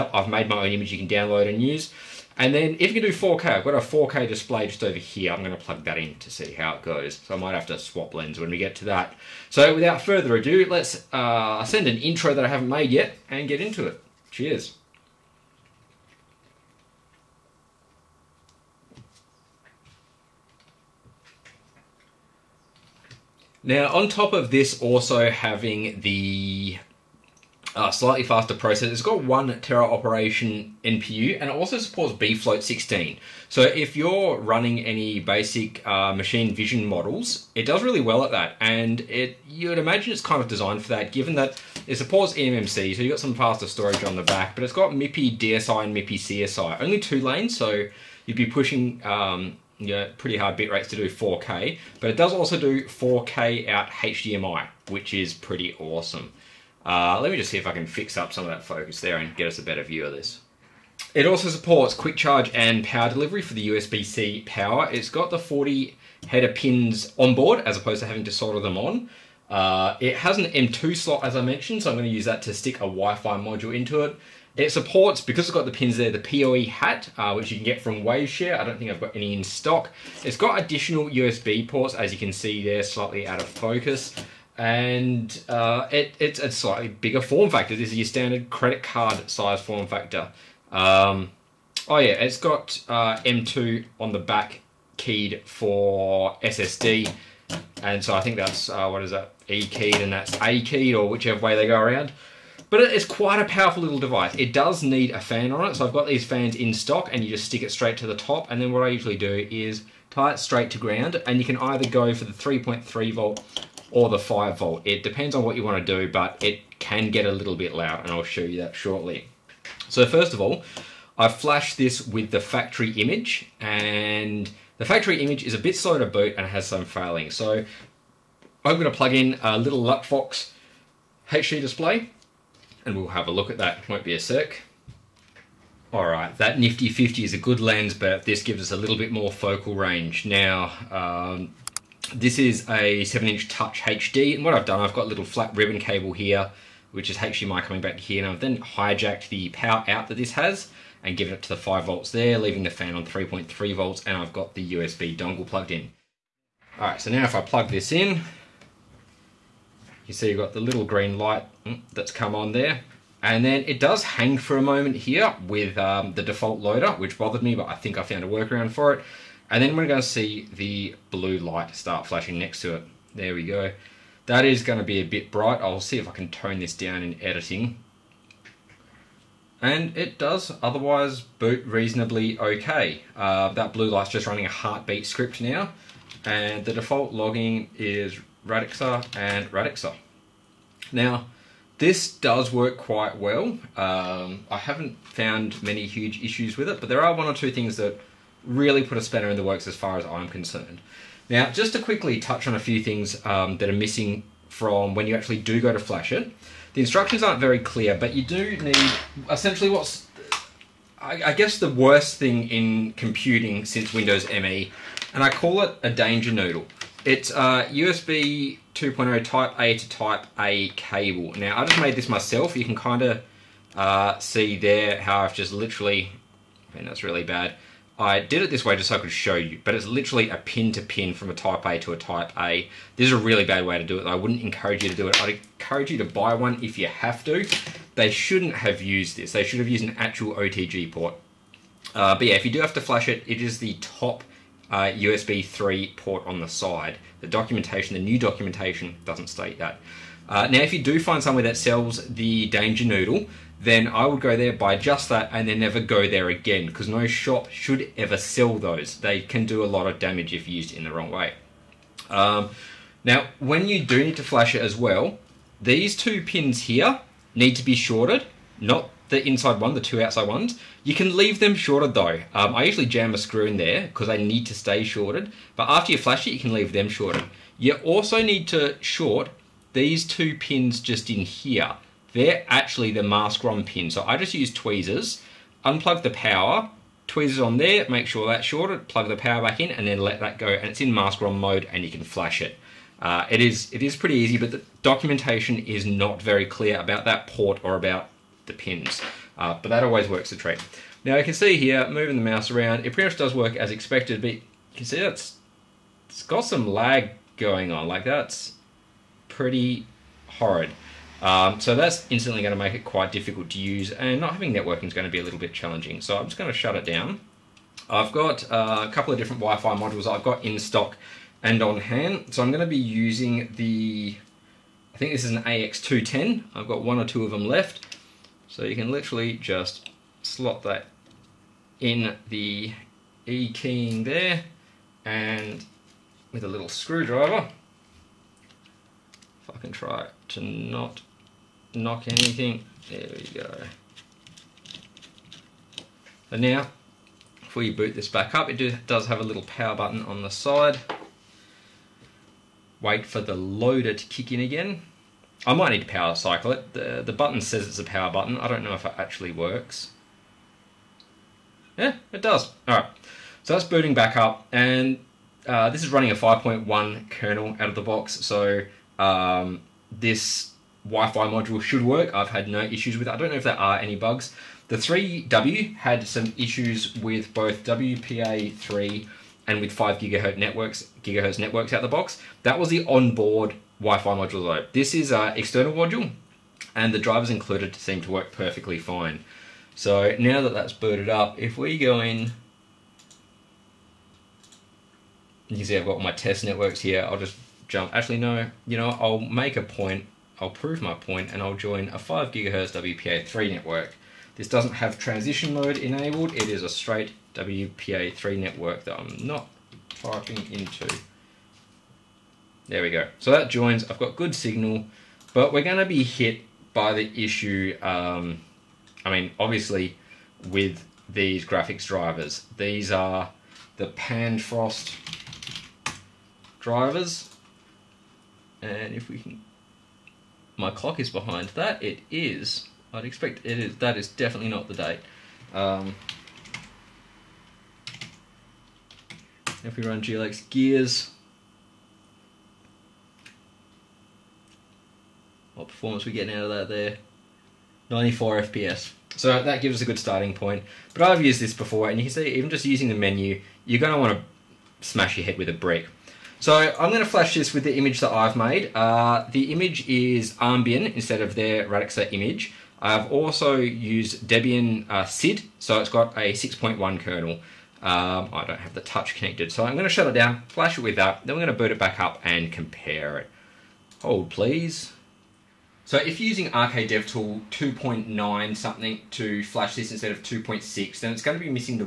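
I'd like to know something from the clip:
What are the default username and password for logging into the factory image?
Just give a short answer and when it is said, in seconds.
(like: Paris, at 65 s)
Radxa and Radxa, at 188 s.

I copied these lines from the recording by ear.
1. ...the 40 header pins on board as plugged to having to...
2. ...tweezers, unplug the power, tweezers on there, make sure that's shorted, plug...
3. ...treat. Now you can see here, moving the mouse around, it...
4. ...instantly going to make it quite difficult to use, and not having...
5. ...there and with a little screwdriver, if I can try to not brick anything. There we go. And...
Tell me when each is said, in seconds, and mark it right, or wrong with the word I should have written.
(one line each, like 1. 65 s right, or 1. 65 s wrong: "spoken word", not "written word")
1. 65 s wrong: "opposed", not "plugged"
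2. 284 s right
3. 300 s right
4. 312 s right
5. 334 s wrong: "knock", not "brick".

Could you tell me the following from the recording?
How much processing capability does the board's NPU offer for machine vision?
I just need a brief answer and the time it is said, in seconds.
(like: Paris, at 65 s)
1 Tera operation, at 29 s.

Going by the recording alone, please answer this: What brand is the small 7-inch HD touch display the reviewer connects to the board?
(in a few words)
Luckfox.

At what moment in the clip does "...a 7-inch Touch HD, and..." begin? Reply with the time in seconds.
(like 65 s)
142 s.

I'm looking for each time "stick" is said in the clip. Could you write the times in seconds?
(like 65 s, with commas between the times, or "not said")
72 s, 107 s.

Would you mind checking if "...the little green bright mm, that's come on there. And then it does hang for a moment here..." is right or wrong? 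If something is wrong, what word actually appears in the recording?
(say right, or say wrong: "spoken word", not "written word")
wrong: "light", not "bright".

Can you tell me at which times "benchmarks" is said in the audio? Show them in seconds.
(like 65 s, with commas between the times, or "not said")
not said.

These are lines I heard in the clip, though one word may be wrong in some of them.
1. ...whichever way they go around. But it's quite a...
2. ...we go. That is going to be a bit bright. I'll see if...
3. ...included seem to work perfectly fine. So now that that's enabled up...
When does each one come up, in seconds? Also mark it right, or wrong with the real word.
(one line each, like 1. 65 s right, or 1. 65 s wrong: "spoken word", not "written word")
1. 101 s right
2. 173 s right
3. 387 s wrong: "booted", not "enabled".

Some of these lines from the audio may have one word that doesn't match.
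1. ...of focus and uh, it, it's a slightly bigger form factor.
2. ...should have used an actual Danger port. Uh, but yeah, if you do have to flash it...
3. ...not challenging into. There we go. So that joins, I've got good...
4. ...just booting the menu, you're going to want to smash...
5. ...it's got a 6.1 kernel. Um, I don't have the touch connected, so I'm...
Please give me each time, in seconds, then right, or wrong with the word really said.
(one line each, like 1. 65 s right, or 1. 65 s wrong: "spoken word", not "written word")
1. 83 s right
2. 239 s wrong: "OTG", not "Danger"
3. 409 s wrong: "typing", not "challenging"
4. 452 s wrong: "using", not "booting"
5. 465 s right.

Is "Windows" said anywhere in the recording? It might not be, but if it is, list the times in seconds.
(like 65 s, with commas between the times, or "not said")
213 s.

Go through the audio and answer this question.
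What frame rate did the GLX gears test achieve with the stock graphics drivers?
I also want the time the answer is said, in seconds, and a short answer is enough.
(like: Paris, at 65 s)
94 FPS, at 447 s.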